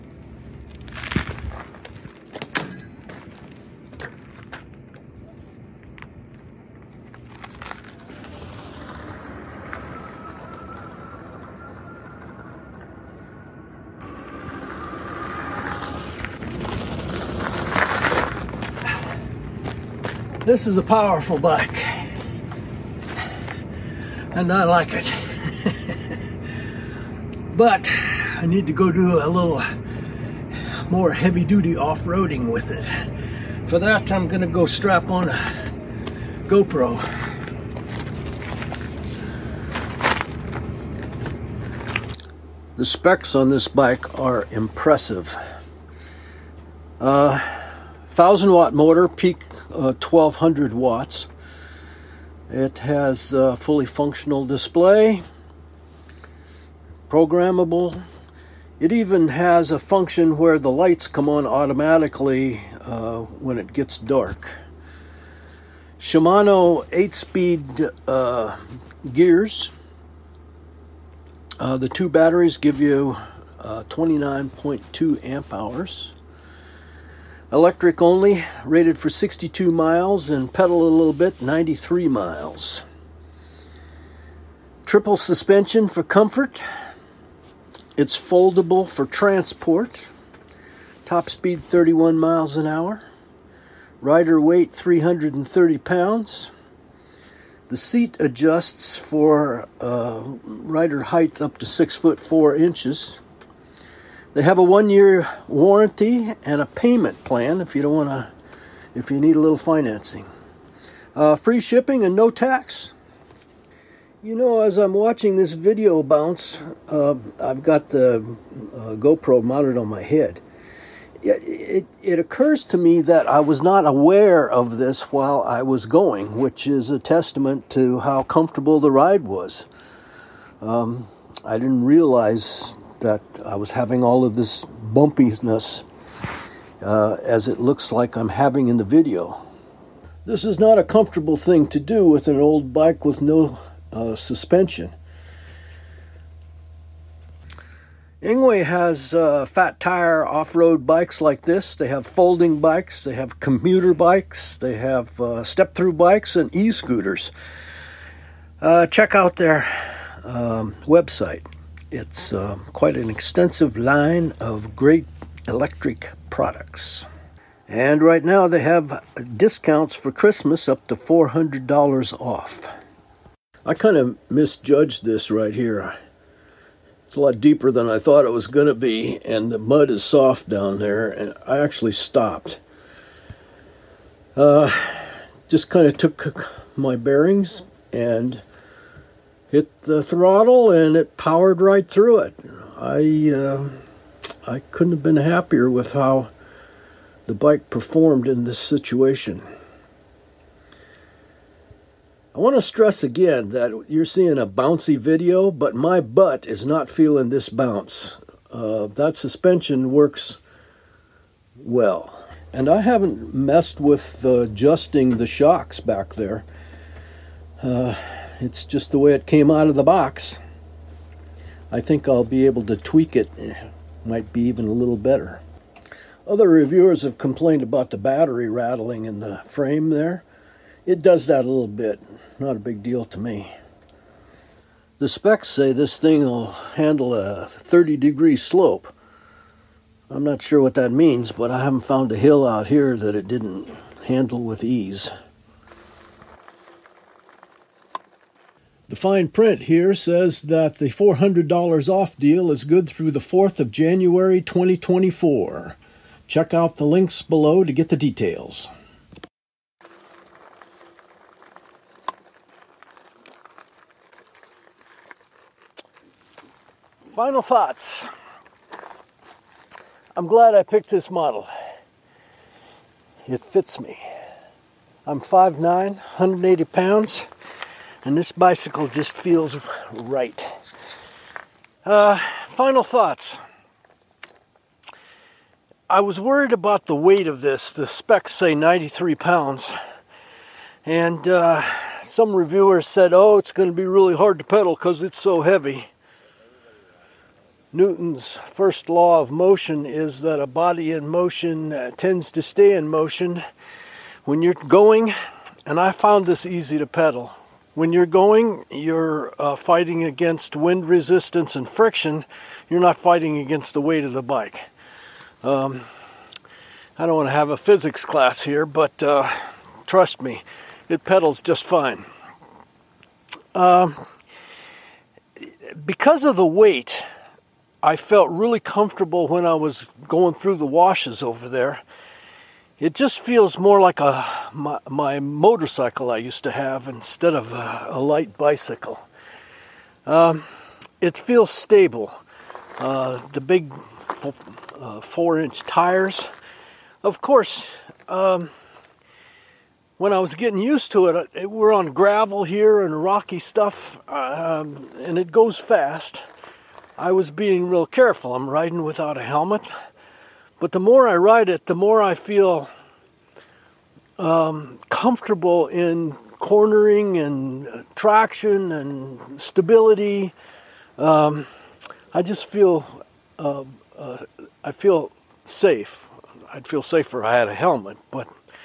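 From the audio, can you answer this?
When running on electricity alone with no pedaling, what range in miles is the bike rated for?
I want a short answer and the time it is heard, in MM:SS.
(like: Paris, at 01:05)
62 miles, at 01:19.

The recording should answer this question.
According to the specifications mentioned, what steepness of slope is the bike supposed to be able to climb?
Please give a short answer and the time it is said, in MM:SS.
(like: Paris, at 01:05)
30 degree, at 03:57.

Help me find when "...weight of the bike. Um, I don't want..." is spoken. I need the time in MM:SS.
05:13.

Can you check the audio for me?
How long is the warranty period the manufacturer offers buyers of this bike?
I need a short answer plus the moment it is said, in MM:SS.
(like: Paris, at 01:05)
one year, at 01:44.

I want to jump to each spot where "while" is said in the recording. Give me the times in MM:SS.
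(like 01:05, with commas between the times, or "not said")
02:05.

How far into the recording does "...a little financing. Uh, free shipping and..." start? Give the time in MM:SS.
01:49.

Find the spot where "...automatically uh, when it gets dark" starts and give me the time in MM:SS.
01:01.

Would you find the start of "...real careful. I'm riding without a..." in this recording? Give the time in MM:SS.
05:57.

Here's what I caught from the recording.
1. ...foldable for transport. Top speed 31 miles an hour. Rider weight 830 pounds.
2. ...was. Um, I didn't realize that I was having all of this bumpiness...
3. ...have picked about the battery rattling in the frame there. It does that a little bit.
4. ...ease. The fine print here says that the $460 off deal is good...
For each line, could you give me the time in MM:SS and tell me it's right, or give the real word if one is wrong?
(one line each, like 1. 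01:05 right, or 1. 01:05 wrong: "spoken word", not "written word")
1. 01:28 wrong: "330", not "830"
2. 02:09 right
3. 03:47 wrong: "complained", not "picked"
4. 04:04 wrong: "400", not "460".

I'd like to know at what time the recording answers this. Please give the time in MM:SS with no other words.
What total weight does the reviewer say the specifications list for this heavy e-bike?
04:48.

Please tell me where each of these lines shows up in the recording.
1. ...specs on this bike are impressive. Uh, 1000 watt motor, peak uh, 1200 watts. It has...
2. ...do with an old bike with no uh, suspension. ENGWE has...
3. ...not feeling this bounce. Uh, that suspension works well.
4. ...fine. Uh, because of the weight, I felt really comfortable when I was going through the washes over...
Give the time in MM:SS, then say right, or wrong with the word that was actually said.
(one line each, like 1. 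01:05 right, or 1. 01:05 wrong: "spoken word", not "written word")
1. 00:42 right
2. 02:21 right
3. 03:26 right
4. 05:21 right.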